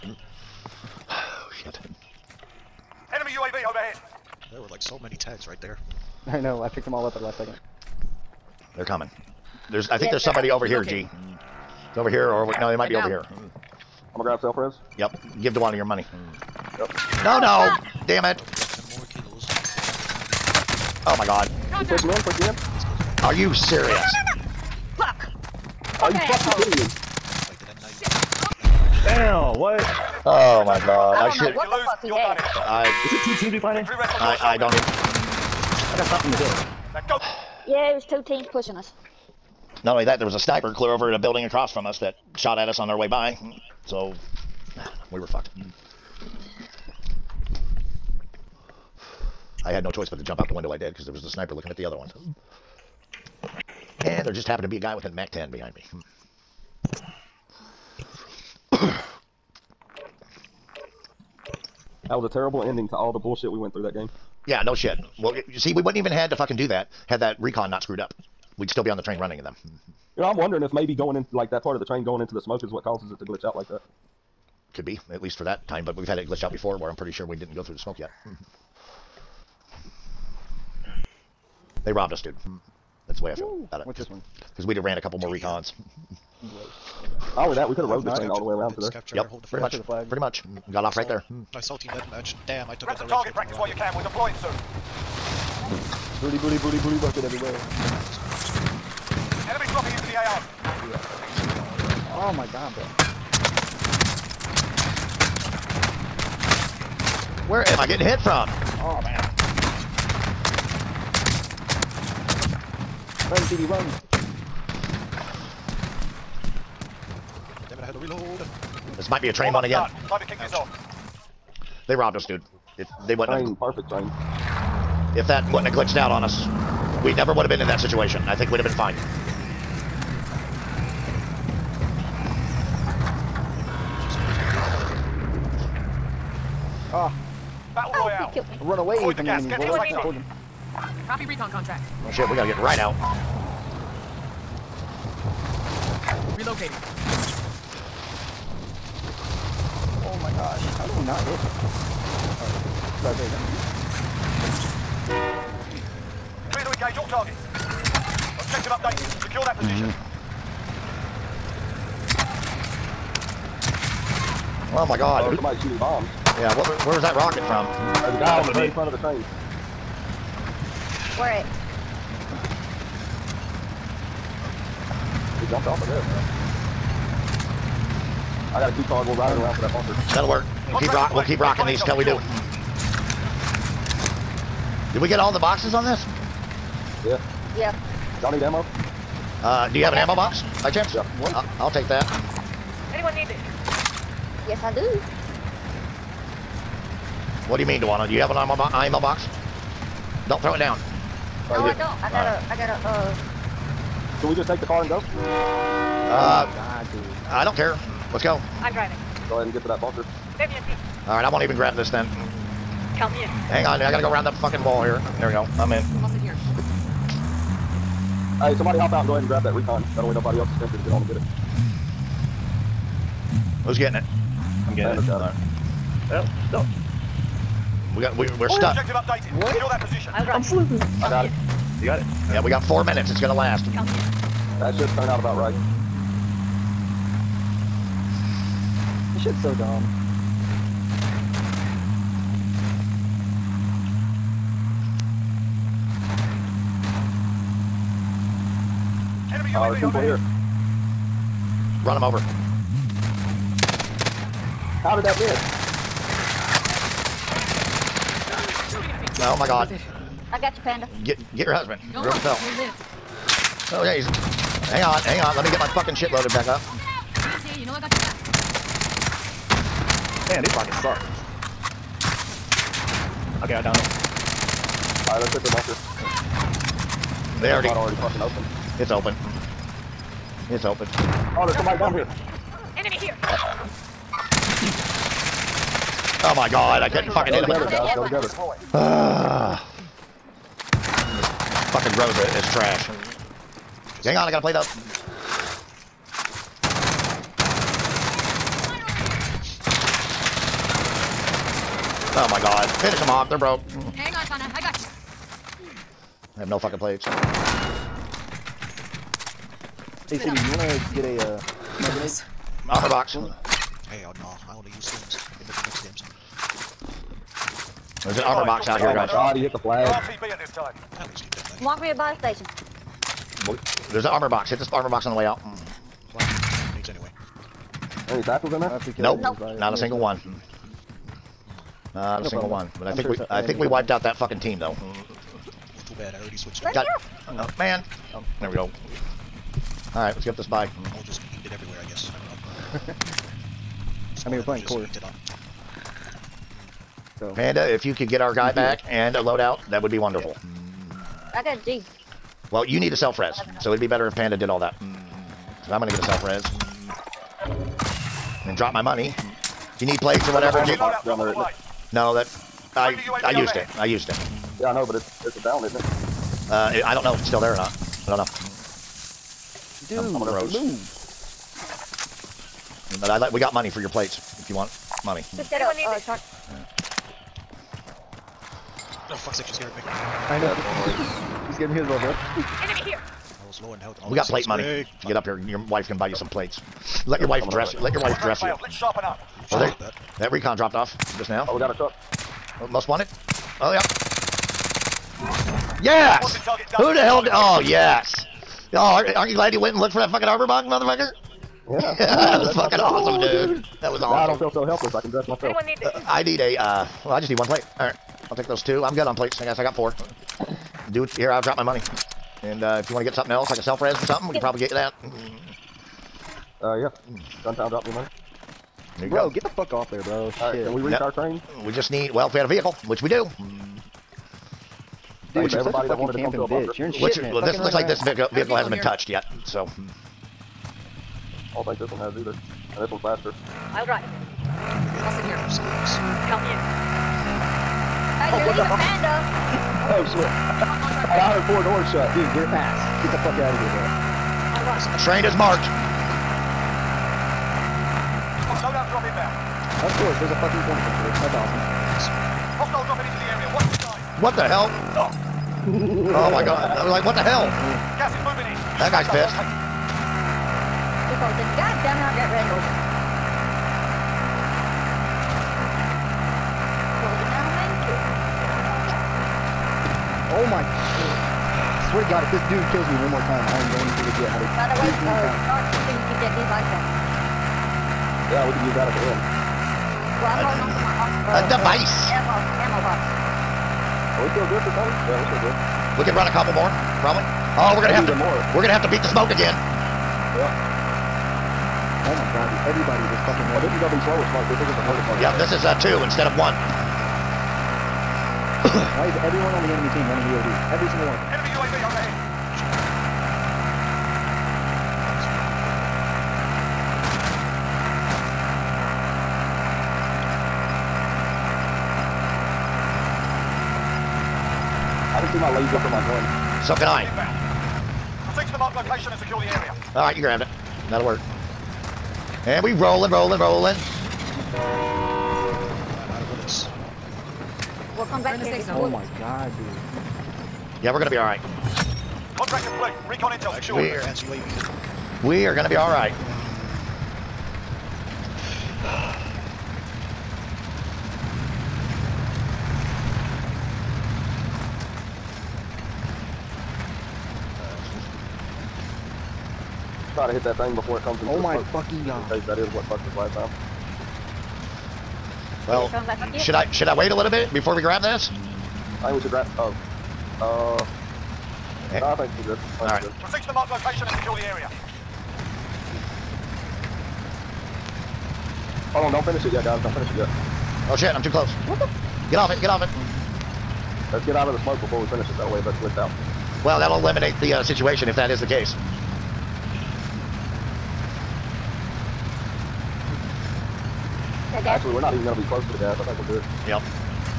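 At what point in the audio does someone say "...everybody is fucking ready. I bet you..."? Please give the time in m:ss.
8:12.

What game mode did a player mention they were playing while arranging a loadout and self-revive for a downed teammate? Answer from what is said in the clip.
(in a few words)
core.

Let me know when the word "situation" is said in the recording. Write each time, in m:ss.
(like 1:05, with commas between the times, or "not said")
2:07, 9:37.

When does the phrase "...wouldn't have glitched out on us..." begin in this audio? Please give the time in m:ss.
2:05.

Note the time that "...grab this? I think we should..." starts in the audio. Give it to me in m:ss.
9:17.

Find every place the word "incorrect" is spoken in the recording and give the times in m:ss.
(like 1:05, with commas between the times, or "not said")
not said.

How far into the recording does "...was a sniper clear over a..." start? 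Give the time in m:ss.
0:40.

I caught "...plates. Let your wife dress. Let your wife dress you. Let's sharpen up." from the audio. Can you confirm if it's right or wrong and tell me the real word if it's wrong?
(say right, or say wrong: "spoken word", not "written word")
right.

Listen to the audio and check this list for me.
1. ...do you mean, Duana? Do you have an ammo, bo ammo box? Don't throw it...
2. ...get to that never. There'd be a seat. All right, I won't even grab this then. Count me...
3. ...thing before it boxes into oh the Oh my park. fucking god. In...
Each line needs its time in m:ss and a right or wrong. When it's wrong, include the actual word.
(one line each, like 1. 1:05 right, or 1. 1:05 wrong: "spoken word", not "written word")
1. 3:17 right
2. 3:29 wrong: "bunker", not "never"
3. 9:10 wrong: "comes", not "boxes".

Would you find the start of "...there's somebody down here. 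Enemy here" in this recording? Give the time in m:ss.
4:41.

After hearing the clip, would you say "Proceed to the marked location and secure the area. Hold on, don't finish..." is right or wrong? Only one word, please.
right.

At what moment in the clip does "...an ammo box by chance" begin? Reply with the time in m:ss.
3:09.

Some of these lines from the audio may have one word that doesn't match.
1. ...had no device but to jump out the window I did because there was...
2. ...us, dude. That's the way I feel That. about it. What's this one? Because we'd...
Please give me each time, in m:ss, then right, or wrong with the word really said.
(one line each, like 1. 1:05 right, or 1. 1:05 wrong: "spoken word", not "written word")
1. 0:49 wrong: "choice", not "device"
2. 1:22 wrong: "Ooh", not "That".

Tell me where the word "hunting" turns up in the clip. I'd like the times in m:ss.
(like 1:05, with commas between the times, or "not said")
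not said.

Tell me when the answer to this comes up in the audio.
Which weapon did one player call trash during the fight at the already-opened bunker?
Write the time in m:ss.
4:51.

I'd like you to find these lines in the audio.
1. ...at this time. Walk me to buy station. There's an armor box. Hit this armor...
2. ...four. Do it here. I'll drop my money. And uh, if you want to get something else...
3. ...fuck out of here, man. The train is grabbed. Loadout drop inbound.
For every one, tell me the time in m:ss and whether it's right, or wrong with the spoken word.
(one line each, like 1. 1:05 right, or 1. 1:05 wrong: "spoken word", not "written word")
1. 5:20 right
2. 6:49 right
3. 7:23 wrong: "marked", not "grabbed".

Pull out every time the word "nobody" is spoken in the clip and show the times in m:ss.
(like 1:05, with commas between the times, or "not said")
3:40.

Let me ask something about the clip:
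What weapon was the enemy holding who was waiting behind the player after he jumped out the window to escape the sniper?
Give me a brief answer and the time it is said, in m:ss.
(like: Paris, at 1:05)
MAC 10, at 0:55.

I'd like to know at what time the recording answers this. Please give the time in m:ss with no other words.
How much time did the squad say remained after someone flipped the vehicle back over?
3:52.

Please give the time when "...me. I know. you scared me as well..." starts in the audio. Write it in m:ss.
6:19.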